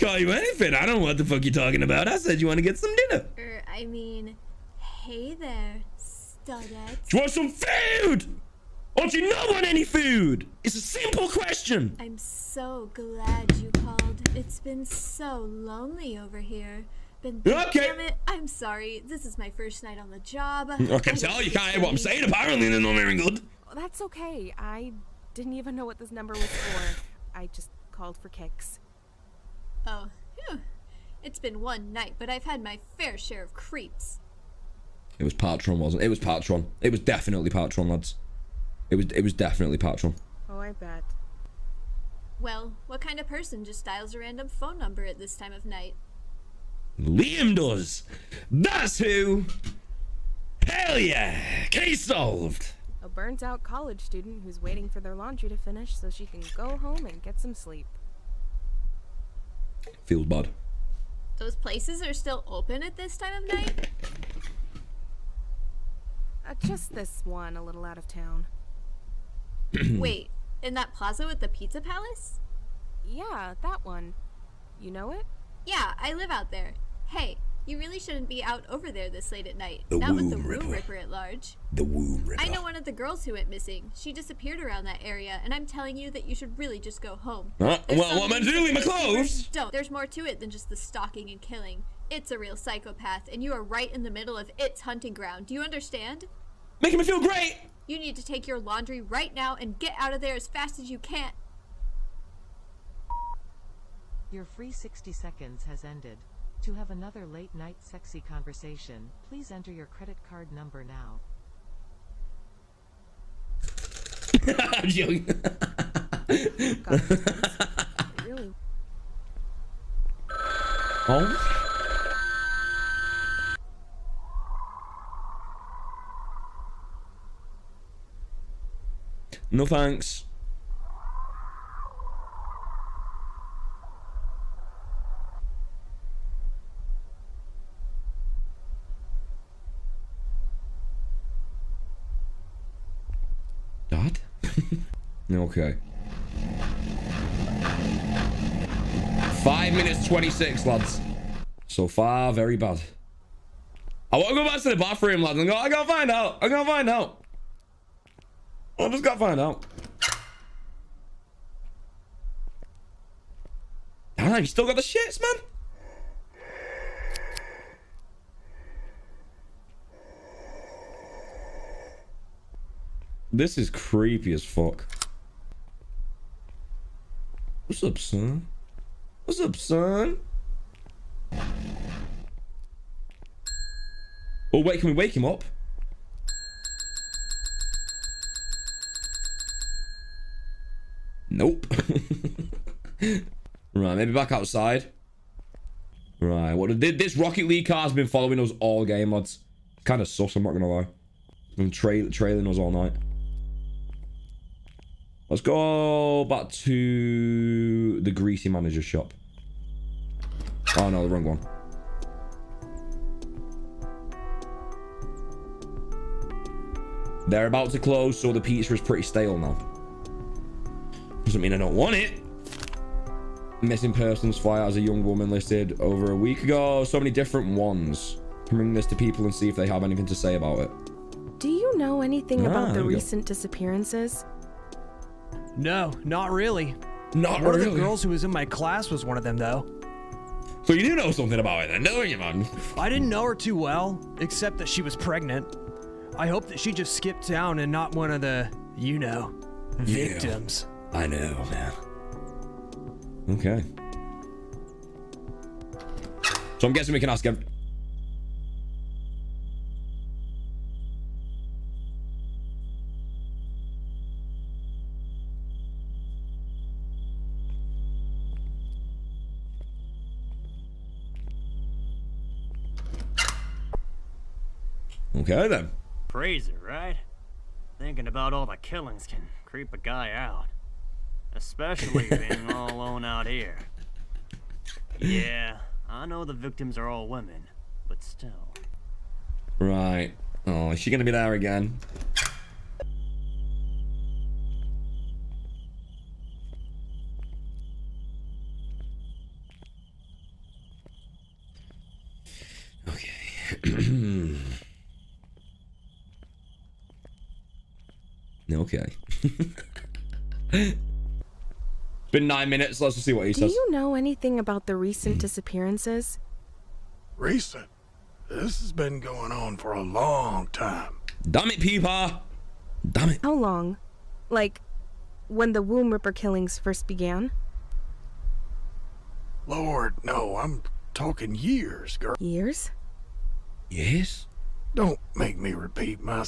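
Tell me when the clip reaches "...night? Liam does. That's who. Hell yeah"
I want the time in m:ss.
0:45.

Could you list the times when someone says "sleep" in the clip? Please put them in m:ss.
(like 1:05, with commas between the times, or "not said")
0:57.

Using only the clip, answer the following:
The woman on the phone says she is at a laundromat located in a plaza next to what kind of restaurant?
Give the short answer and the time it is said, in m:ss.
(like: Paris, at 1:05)
Pizza palace, at 1:11.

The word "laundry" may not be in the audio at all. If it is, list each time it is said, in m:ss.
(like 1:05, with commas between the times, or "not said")
0:55, 1:38.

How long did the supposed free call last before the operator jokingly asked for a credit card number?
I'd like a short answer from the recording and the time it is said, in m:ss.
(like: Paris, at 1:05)
60 seconds, at 1:44.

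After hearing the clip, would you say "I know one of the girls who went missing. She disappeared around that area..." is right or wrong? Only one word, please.
right.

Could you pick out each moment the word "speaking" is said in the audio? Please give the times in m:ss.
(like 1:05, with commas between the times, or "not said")
not said.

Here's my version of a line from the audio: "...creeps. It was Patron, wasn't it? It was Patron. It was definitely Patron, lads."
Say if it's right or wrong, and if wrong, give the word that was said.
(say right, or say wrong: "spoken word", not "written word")
right.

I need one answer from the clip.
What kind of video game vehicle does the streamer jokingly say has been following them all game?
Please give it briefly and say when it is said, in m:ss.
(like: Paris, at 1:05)
Rocket League car, at 3:17.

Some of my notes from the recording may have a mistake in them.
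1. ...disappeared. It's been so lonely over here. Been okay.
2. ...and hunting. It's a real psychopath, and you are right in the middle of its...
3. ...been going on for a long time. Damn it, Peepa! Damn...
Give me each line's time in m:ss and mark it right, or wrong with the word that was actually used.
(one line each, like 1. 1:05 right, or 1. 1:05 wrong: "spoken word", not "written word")
1. 0:13 wrong: "called", not "disappeared"
2. 1:31 wrong: "killing", not "hunting"
3. 5:18 right.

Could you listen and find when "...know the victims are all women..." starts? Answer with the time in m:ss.
4:46.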